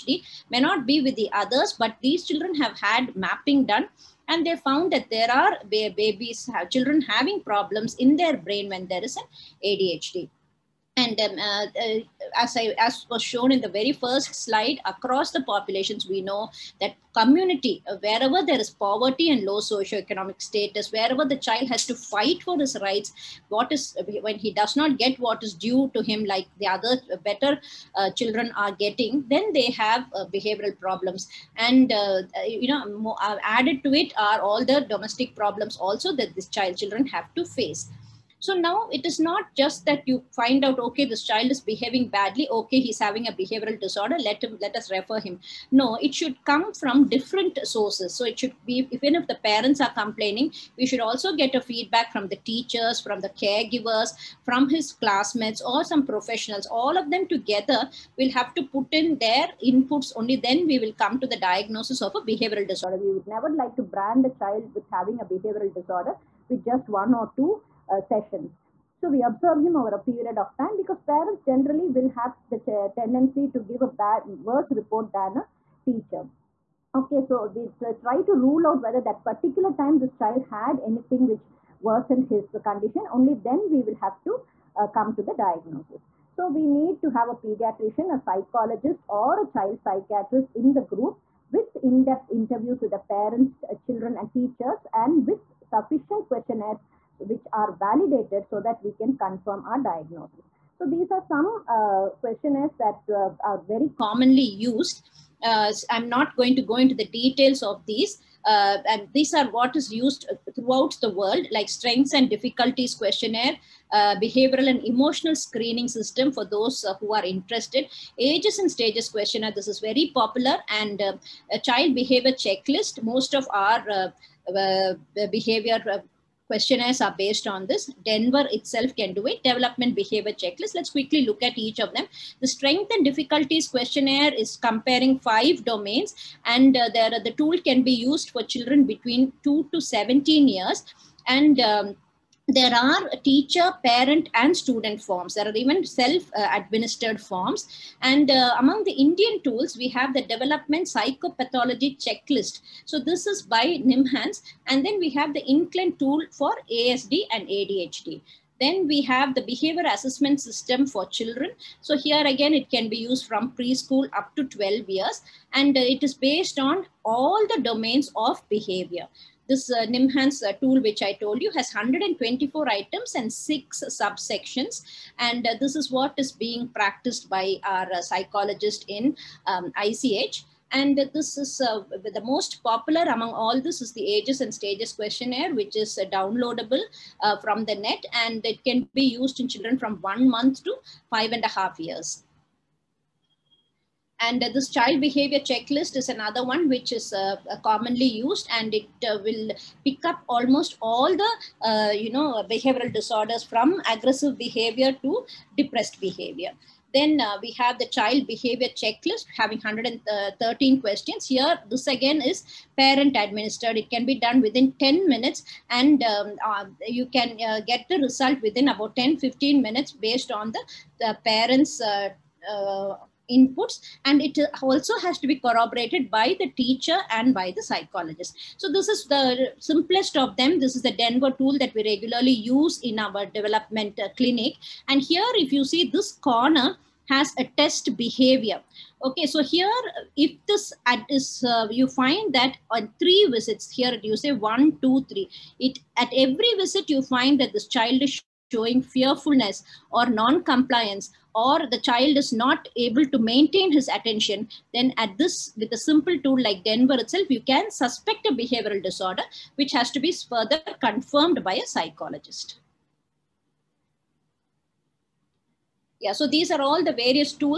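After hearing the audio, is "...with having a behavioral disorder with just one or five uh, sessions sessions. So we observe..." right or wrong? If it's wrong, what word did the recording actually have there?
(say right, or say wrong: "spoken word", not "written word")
wrong: "two", not "five".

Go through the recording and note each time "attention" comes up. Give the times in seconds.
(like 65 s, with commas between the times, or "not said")
253 s.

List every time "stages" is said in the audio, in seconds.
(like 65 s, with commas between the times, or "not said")
118 s, 184 s.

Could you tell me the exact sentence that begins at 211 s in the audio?
Here, this again is parent administered.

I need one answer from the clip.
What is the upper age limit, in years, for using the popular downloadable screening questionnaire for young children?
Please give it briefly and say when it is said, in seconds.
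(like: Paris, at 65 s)
5.5 years, at 191 s.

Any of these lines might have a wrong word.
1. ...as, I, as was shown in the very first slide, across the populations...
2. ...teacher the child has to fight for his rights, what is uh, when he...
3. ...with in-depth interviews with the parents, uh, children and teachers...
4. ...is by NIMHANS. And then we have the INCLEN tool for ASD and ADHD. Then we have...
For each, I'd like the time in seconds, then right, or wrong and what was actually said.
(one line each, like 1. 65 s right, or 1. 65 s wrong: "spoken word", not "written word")
1. 12 s right
2. 20 s wrong: "wherever", not "teacher"
3. 91 s right
4. 153 s right.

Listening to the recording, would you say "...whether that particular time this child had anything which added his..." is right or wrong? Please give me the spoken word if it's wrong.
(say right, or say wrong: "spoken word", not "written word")
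wrong: "worsened", not "added".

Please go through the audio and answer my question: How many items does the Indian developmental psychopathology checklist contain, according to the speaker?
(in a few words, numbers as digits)
124.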